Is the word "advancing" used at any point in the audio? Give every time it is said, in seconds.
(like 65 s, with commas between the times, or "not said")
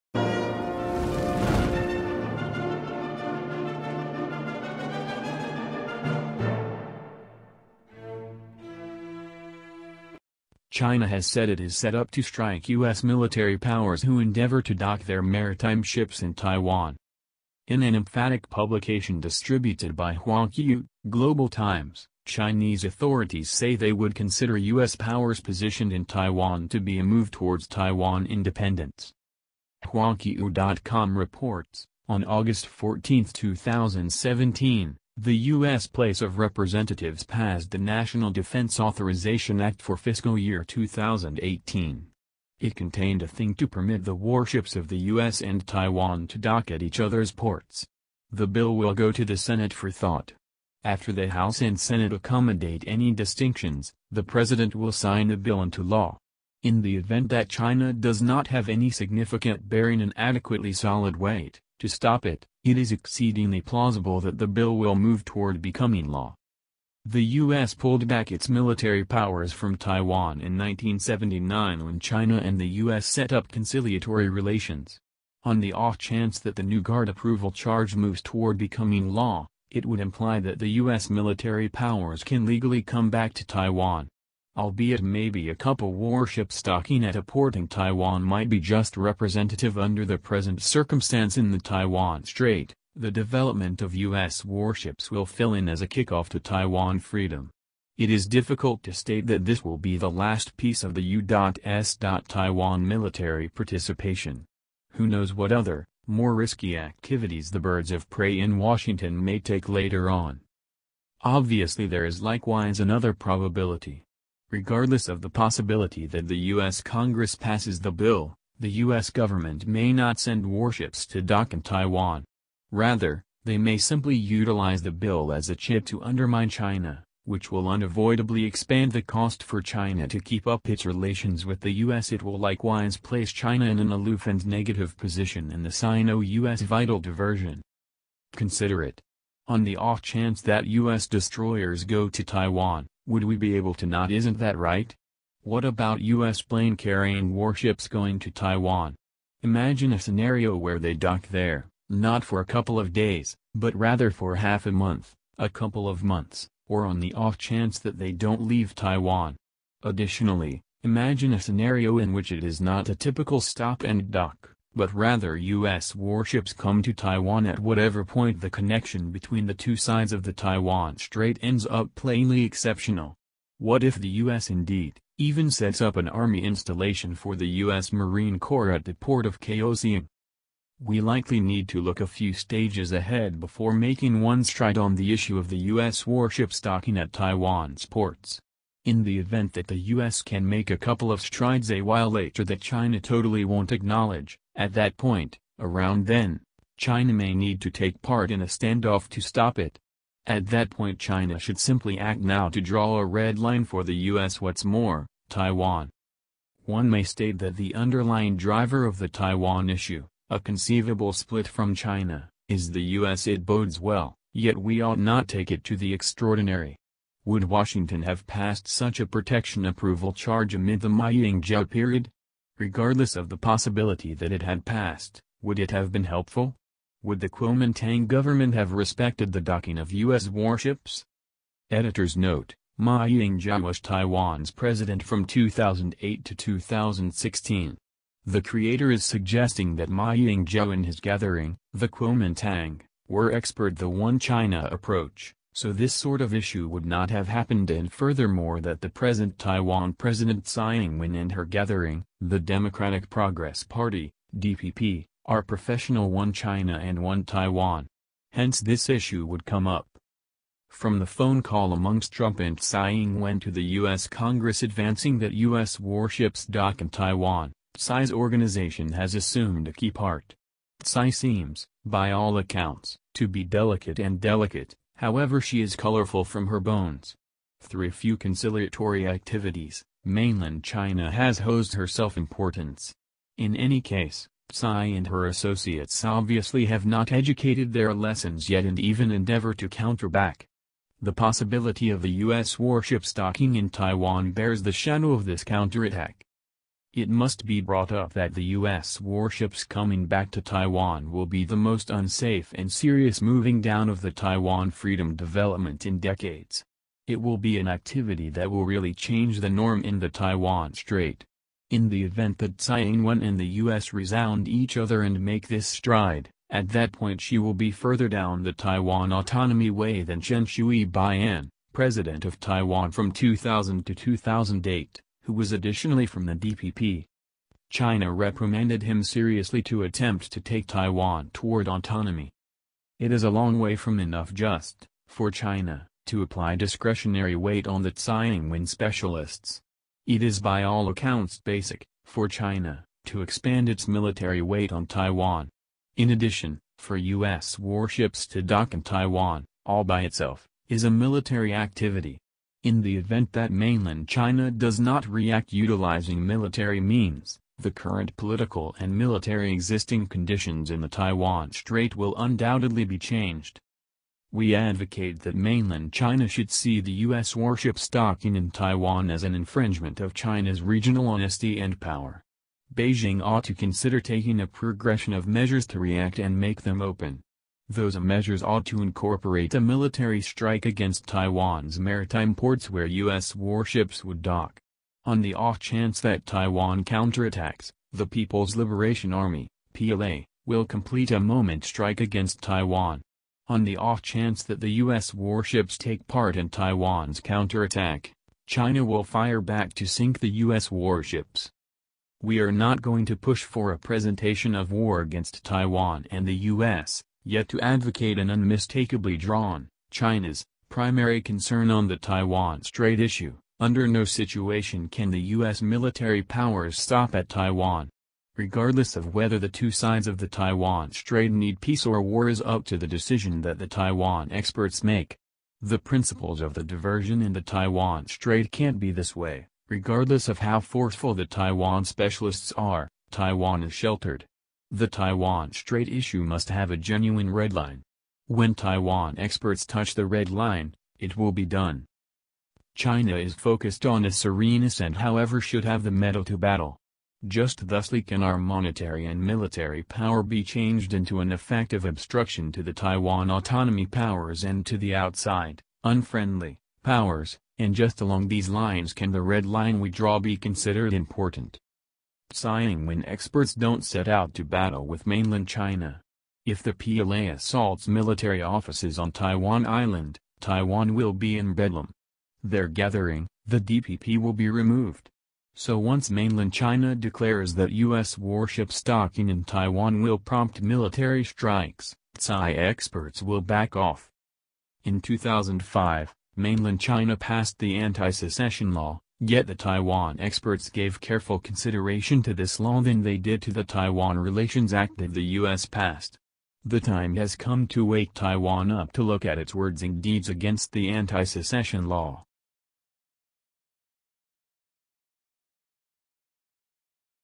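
264 s.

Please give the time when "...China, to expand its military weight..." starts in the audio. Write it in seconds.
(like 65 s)
342 s.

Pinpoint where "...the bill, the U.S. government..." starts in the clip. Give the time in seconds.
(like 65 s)
117 s.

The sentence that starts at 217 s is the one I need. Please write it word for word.
Would Washington have passed such a protection approval charge amid the Ma Ying-jeou period?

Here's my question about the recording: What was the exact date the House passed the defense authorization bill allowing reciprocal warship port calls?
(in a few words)
August 14, 2017.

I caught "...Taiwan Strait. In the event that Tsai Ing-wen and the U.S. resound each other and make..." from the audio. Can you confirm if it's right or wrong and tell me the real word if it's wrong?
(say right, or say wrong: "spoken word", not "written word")
right.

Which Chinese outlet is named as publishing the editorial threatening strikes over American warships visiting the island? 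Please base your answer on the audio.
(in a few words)
Huanqiu.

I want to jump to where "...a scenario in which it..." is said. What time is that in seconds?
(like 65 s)
161 s.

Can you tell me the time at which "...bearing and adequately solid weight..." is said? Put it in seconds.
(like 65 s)
59 s.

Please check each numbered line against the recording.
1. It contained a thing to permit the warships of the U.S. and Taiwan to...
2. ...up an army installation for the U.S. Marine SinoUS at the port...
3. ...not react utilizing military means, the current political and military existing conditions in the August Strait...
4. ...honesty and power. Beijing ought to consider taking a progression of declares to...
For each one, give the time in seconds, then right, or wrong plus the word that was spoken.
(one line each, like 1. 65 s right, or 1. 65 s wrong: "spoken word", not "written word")
1. 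42 s right
2. 175 s wrong: "Corps", not "SinoUS"
3. 354 s wrong: "Taiwan", not "August"
4. 371 s wrong: "measures", not "declares".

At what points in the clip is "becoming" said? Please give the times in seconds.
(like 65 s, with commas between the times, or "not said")
65 s, 78 s.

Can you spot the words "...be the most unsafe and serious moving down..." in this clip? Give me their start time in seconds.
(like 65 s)
301 s.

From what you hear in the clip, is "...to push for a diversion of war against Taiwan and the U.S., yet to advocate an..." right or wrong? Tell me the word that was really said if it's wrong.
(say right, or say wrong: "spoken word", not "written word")
wrong: "presentation", not "diversion".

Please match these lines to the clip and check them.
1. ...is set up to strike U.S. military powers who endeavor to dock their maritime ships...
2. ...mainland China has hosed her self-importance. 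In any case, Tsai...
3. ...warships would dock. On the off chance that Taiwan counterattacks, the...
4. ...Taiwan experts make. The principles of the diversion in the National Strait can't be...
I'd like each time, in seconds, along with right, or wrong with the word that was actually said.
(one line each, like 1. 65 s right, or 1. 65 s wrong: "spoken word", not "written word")
1. 11 s right
2. 280 s right
3. 383 s right
4. 423 s wrong: "Taiwan", not "National".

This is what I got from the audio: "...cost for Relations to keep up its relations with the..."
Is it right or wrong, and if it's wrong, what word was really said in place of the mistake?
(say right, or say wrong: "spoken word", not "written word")
wrong: "China", not "Relations".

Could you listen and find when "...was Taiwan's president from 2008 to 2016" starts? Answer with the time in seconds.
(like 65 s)
233 s.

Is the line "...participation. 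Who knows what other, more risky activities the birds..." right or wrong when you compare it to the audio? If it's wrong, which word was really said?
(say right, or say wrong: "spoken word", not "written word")
right.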